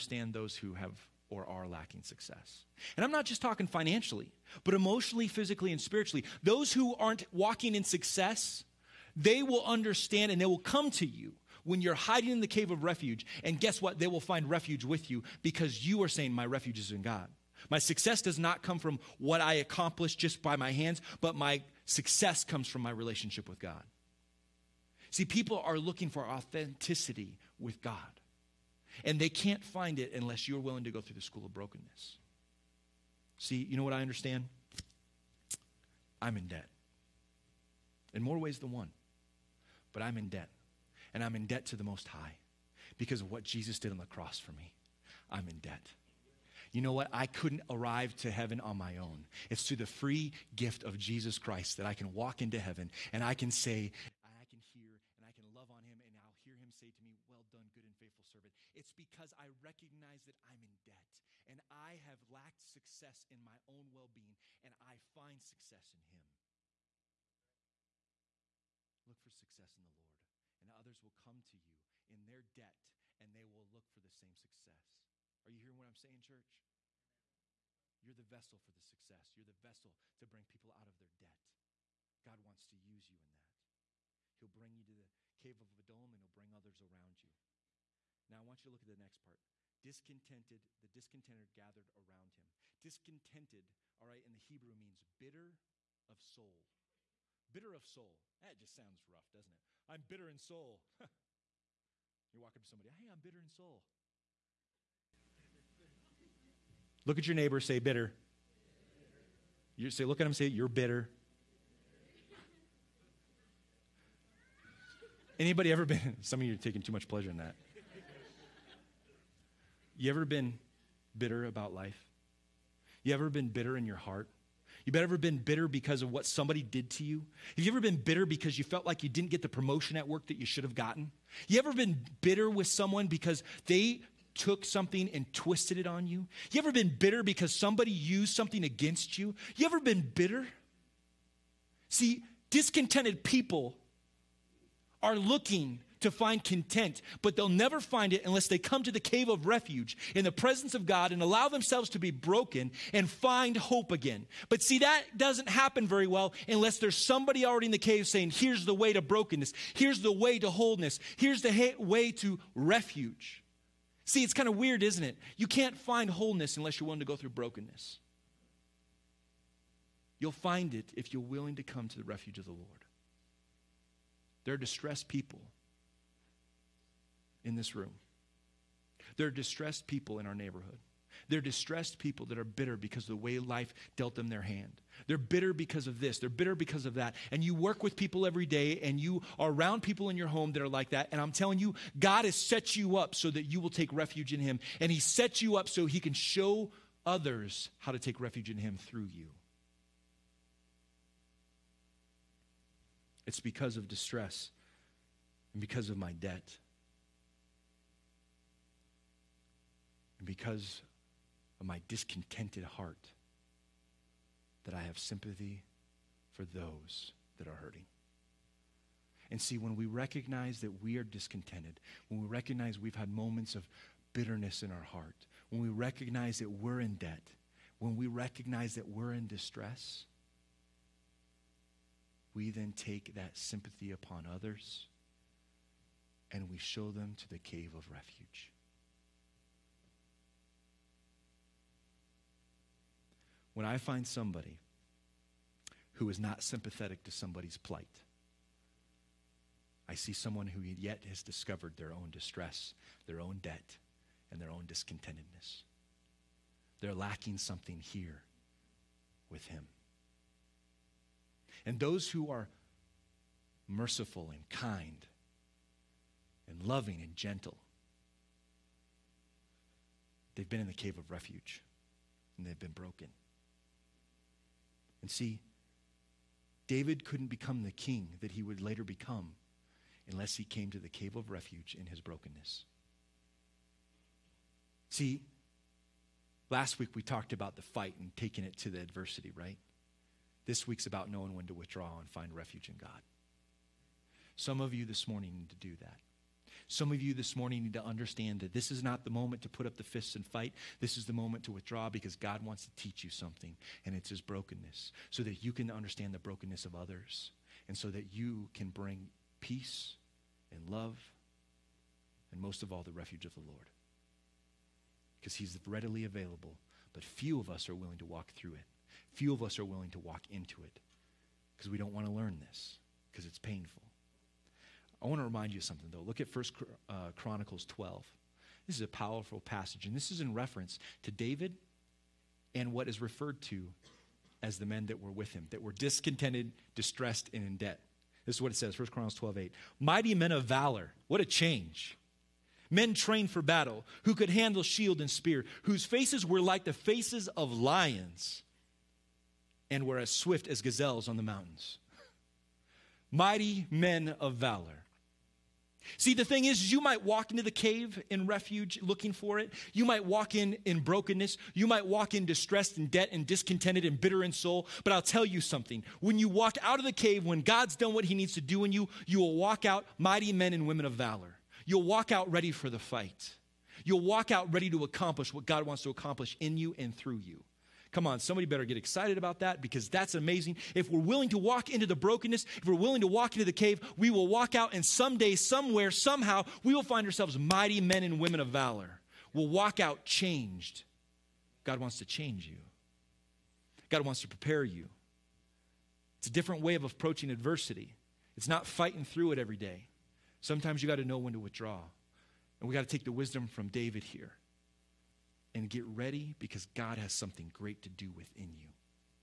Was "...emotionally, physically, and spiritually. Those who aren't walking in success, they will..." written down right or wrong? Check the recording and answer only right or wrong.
right.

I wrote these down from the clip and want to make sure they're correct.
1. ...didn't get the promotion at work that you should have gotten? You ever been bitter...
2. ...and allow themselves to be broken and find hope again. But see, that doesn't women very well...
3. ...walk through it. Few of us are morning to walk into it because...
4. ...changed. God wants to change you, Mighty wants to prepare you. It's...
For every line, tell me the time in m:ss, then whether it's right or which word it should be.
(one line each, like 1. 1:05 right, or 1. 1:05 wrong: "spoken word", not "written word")
1. 2:09 right
2. 2:31 wrong: "happen", not "women"
3. 5:18 wrong: "willing", not "morning"
4. 6:30 wrong: "God", not "Mighty".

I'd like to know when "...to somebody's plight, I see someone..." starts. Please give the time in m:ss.
4:07.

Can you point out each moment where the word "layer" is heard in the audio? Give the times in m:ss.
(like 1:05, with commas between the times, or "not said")
not said.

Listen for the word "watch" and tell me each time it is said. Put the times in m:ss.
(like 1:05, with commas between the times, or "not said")
not said.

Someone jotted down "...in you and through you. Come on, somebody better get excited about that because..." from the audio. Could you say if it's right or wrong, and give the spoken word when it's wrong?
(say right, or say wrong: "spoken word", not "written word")
right.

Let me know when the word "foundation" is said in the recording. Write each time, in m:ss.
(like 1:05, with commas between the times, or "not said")
not said.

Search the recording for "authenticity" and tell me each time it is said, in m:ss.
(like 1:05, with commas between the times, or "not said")
0:26.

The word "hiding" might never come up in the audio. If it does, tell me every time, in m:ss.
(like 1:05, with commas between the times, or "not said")
0:11.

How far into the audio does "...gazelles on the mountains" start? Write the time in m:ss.
5:50.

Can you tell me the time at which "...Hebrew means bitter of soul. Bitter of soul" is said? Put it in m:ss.
1:34.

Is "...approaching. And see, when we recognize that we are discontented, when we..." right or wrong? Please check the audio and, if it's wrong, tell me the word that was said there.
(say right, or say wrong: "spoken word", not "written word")
wrong: "hurting", not "approaching".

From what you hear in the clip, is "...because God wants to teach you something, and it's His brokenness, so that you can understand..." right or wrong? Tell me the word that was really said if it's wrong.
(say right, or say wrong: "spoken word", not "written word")
right.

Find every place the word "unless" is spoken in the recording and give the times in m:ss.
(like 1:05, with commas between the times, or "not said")
0:30, 2:28, 2:36, 2:46, 4:40.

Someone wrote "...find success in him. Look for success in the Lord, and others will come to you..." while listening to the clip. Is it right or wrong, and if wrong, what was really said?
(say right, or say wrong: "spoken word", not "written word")
right.